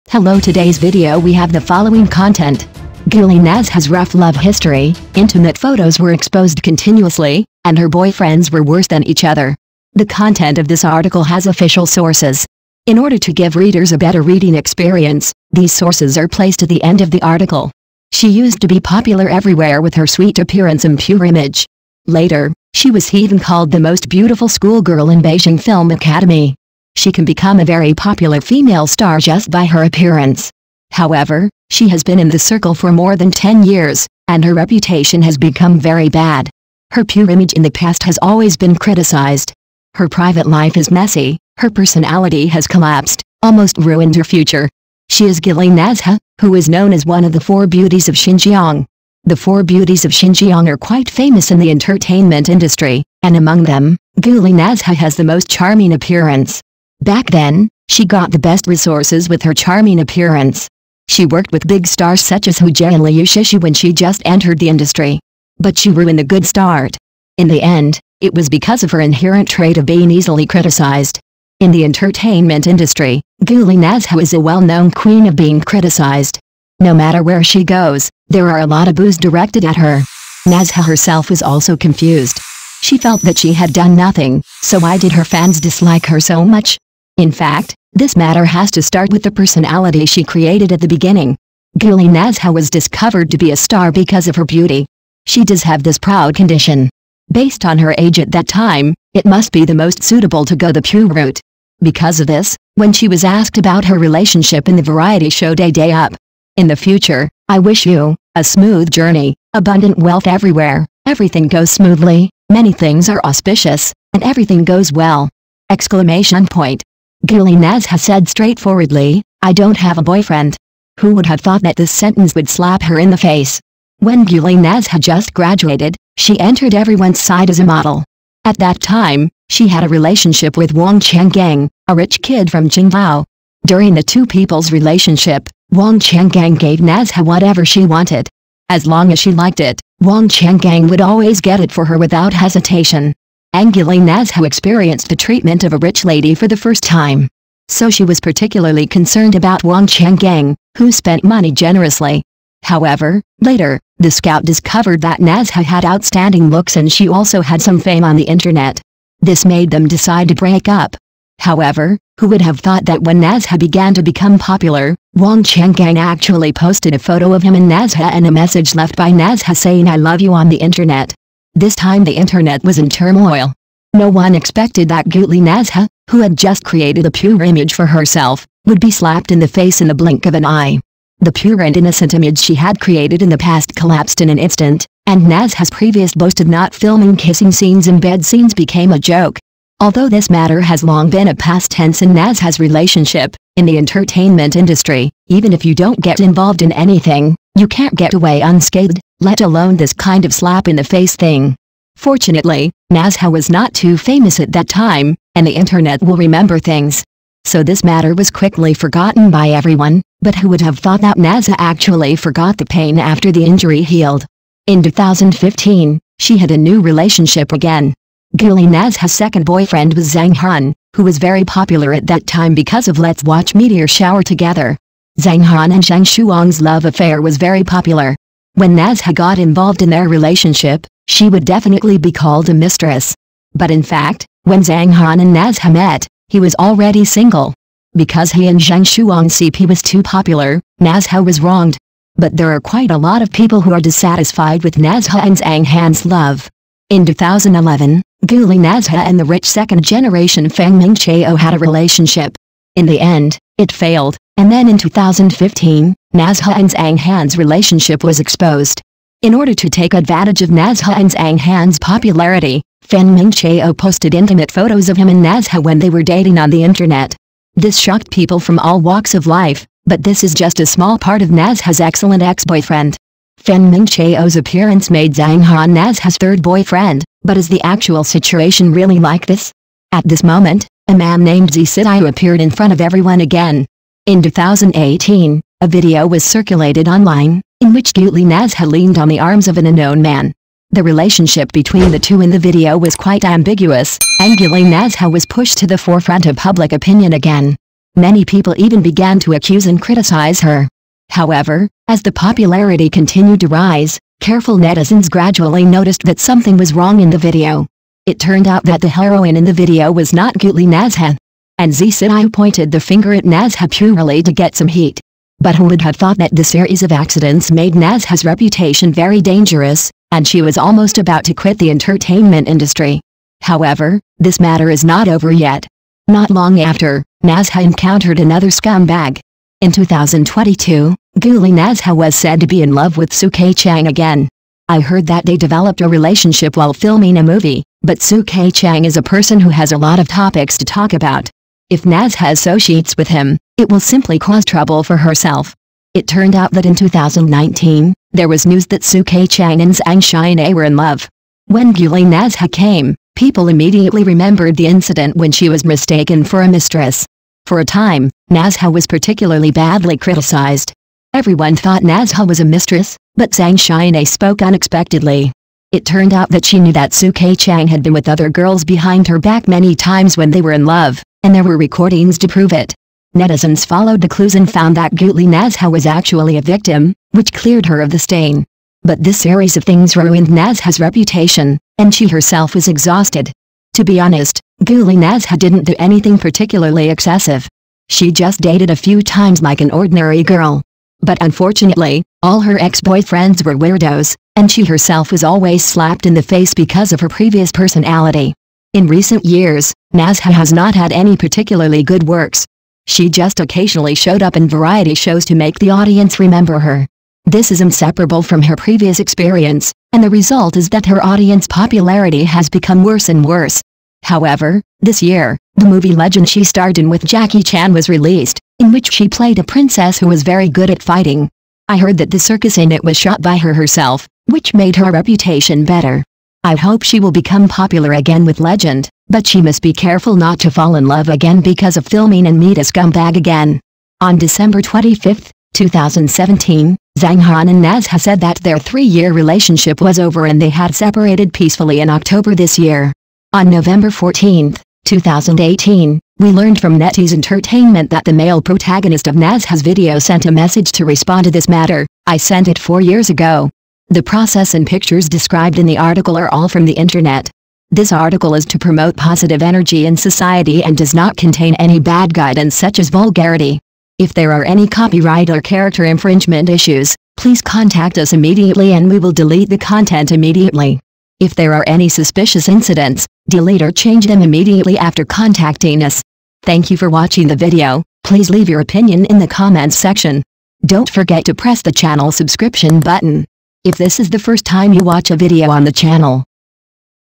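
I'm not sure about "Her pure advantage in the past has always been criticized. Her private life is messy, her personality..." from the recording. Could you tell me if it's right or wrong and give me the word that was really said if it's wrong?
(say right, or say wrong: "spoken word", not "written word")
wrong: "image", not "advantage".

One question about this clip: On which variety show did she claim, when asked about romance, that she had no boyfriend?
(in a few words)
Day Day Up.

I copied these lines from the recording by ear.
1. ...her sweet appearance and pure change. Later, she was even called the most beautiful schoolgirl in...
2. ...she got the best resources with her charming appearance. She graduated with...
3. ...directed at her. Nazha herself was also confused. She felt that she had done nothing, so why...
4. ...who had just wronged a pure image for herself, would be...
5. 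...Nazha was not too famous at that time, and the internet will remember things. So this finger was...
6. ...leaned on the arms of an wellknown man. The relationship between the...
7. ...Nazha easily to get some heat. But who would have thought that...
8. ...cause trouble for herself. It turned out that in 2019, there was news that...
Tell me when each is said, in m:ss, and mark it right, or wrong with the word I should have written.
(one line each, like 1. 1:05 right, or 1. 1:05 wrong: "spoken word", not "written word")
1. 0:19 wrong: "image", not "change"
2. 0:57 wrong: "worked", not "graduated"
3. 1:19 right
4. 2:56 wrong: "created", not "wronged"
5. 3:22 wrong: "matter", not "finger"
6. 4:48 wrong: "unknown", not "wellknown"
7. 5:13 wrong: "purely", not "easily"
8. 5:44 right.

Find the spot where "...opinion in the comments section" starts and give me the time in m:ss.
7:58.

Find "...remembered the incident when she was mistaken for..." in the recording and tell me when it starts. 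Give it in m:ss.
5:54.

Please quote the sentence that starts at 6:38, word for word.
In recent years, Nazha has not had any particularly good works.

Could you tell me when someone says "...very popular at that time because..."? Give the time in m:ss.
3:41.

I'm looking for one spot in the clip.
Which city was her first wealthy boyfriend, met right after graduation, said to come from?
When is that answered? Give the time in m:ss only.
2:12.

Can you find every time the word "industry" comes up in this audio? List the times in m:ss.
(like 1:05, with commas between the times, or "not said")
0:52, 1:04, 1:12, 3:14, 5:22.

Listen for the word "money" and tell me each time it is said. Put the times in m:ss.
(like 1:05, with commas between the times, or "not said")
2:31.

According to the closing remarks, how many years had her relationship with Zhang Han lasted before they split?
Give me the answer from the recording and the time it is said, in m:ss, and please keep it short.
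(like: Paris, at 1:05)
3, at 7:18.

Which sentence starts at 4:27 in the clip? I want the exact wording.
This shocked people from all walks of life, but this is just a small part of Nazha's excellent ex-boyfriend.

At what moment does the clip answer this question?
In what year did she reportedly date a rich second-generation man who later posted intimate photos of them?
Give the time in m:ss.
4:07.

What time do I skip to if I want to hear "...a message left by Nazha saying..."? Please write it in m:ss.
2:48.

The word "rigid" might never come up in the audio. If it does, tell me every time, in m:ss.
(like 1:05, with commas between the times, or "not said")
not said.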